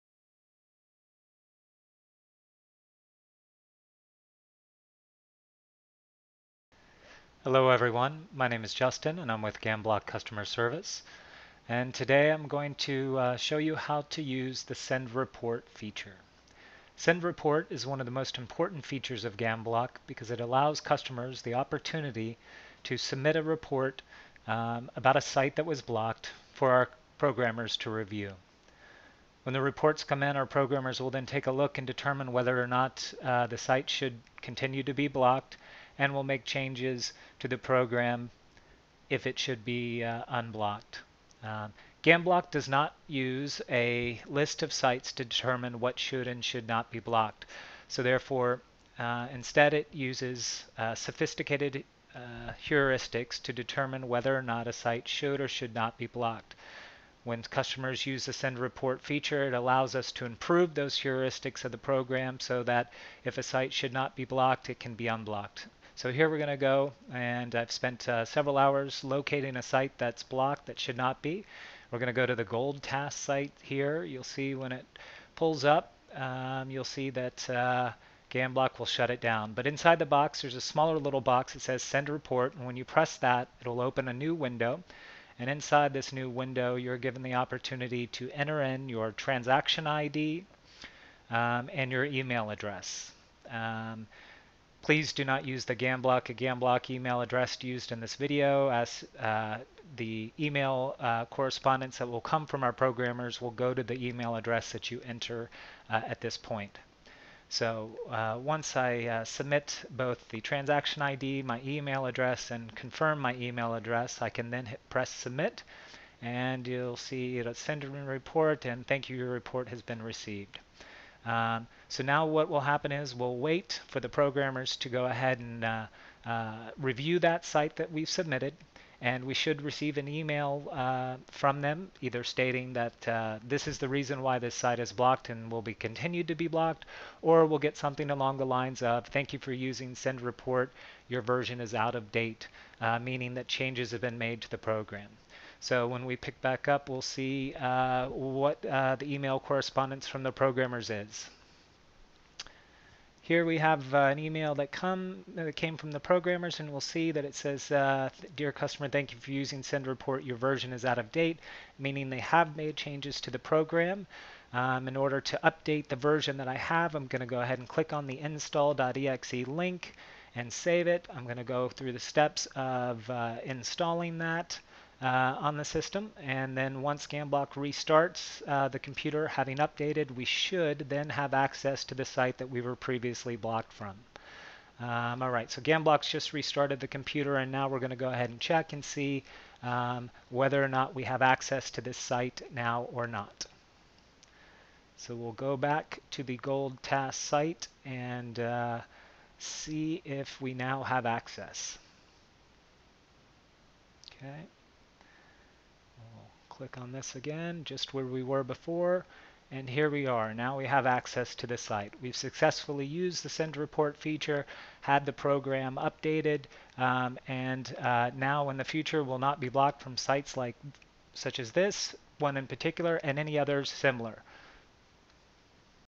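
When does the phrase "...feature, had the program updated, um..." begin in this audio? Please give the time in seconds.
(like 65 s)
213 s.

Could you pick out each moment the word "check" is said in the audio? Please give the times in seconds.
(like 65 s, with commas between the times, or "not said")
188 s.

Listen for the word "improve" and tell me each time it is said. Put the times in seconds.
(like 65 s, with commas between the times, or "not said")
60 s.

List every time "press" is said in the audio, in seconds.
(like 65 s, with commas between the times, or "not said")
82 s, 114 s.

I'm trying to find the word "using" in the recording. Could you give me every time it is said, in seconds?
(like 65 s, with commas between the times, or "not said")
139 s, 159 s.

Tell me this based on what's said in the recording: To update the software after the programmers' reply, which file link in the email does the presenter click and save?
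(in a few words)
install.exe.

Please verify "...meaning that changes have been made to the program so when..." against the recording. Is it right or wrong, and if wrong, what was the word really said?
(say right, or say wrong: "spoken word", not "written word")
right.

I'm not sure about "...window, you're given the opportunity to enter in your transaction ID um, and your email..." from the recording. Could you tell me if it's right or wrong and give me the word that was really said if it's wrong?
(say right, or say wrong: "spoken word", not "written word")
right.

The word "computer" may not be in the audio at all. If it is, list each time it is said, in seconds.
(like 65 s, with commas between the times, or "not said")
178 s, 186 s.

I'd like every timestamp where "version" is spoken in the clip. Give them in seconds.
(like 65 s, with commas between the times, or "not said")
141 s, 160 s, 165 s.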